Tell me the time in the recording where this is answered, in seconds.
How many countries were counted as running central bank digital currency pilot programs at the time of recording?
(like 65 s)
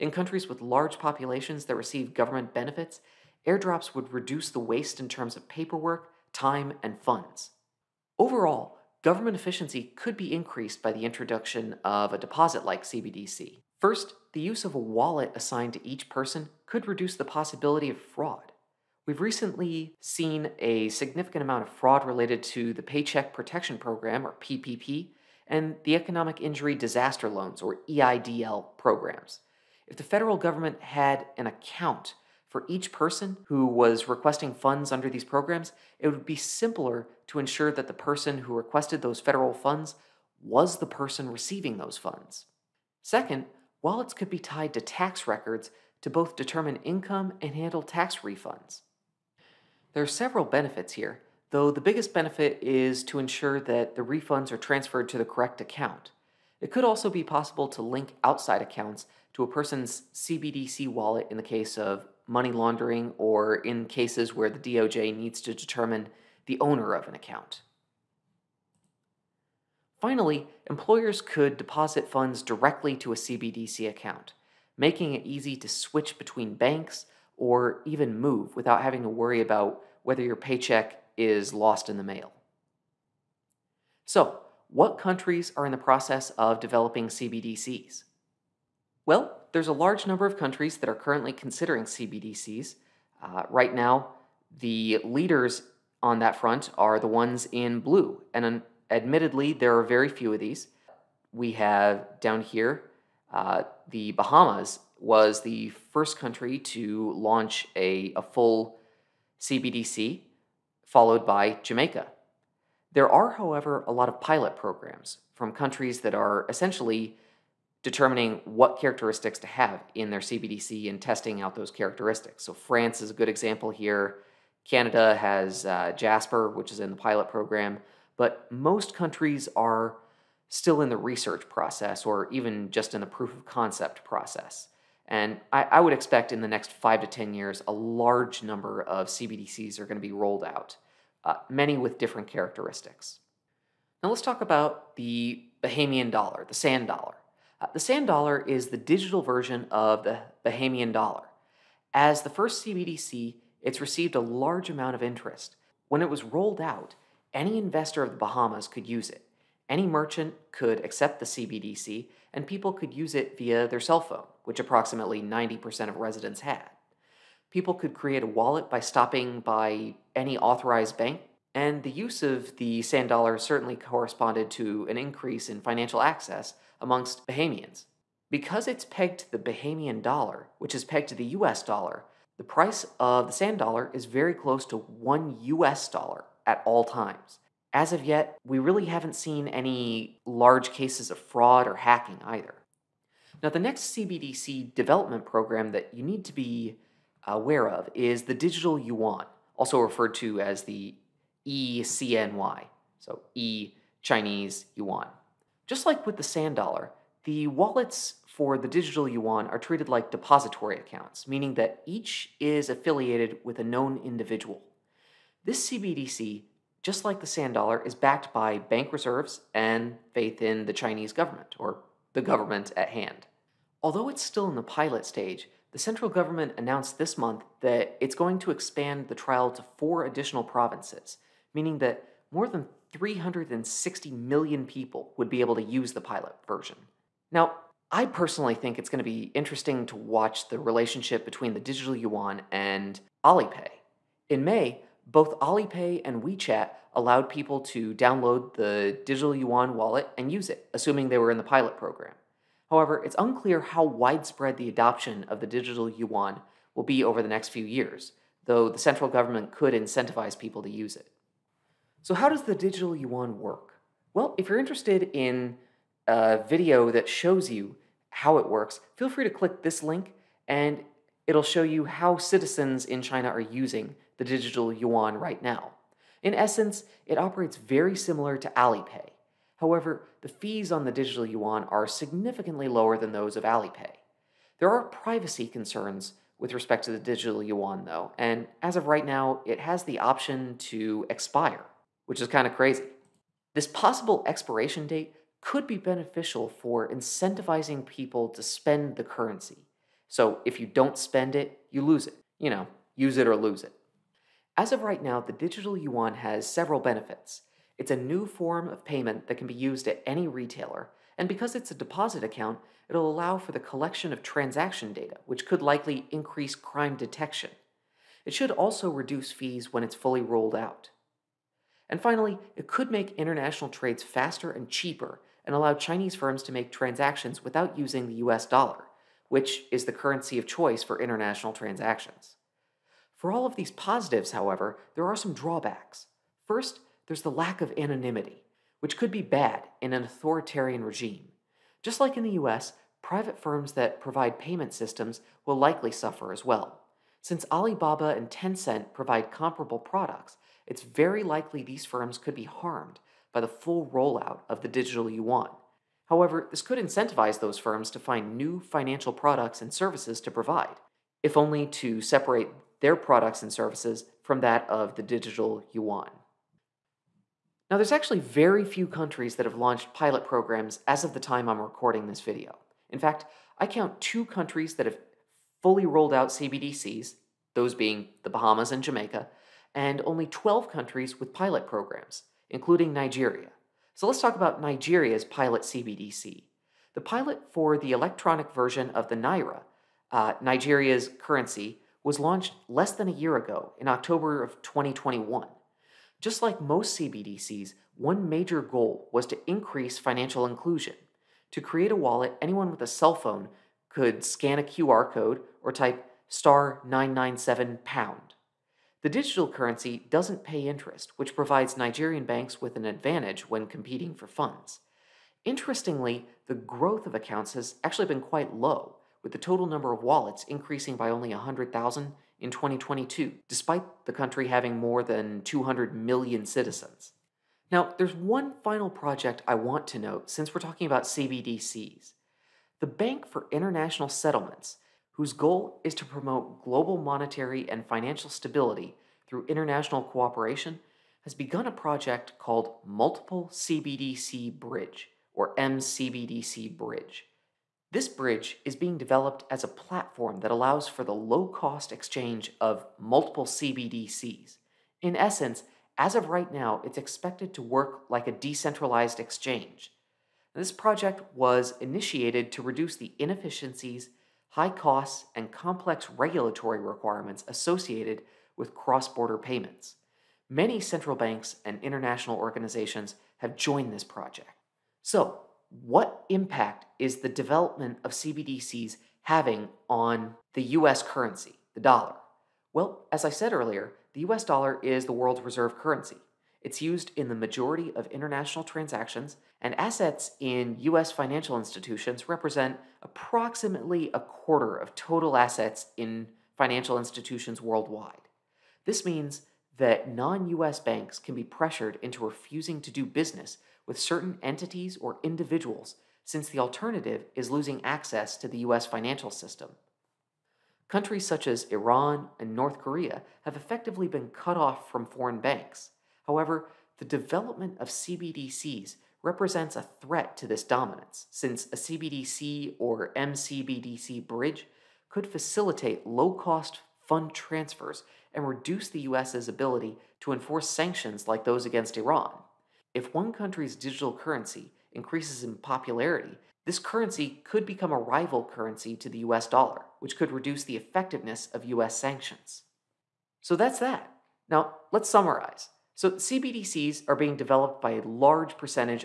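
380 s.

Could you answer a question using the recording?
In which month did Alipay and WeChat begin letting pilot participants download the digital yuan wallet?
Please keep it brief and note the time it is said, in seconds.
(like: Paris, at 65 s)
May, at 244 s.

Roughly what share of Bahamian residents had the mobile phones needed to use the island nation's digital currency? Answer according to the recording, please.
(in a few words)
90%.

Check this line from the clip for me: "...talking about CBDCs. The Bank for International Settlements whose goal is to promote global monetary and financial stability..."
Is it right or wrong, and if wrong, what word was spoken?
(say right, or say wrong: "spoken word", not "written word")
right.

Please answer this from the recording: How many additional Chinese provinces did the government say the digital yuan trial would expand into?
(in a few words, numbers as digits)
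4.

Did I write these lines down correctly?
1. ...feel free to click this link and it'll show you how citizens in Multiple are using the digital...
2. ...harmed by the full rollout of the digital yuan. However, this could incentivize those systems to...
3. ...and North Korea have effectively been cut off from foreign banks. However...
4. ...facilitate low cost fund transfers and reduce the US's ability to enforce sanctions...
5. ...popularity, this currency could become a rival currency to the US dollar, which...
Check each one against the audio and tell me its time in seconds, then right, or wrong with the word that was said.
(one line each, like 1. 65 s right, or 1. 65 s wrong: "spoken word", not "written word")
1. 268 s wrong: "China", not "Multiple"
2. 352 s wrong: "firms", not "systems"
3. 512 s right
4. 525 s right
5. 535 s right.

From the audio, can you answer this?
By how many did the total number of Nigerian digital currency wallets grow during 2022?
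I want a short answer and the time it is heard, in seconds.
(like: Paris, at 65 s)
100,000, at 421 s.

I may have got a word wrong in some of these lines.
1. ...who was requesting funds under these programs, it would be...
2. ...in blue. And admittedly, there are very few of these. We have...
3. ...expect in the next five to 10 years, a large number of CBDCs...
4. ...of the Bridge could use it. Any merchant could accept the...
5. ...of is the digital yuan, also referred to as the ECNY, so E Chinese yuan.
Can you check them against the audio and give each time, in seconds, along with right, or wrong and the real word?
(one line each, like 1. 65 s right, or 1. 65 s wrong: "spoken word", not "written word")
1. 33 s right
2. 97 s right
3. 135 s right
4. 158 s wrong: "Bahamas", not "Bridge"
5. 197 s right.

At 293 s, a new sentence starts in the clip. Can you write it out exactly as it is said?
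This possible expiration date could be beneficial for incentivizing people to spend the currency.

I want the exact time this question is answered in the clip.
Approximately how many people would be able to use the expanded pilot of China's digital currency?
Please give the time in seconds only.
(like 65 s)
232 s.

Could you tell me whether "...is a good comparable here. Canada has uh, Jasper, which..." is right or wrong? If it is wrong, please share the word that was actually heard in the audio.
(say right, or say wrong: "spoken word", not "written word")
wrong: "example", not "comparable".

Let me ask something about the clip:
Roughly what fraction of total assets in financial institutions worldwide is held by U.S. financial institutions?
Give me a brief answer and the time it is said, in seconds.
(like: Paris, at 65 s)
a quarter, at 494 s.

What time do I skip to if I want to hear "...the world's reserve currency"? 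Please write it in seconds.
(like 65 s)
485 s.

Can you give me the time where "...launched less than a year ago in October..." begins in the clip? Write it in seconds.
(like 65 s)
392 s.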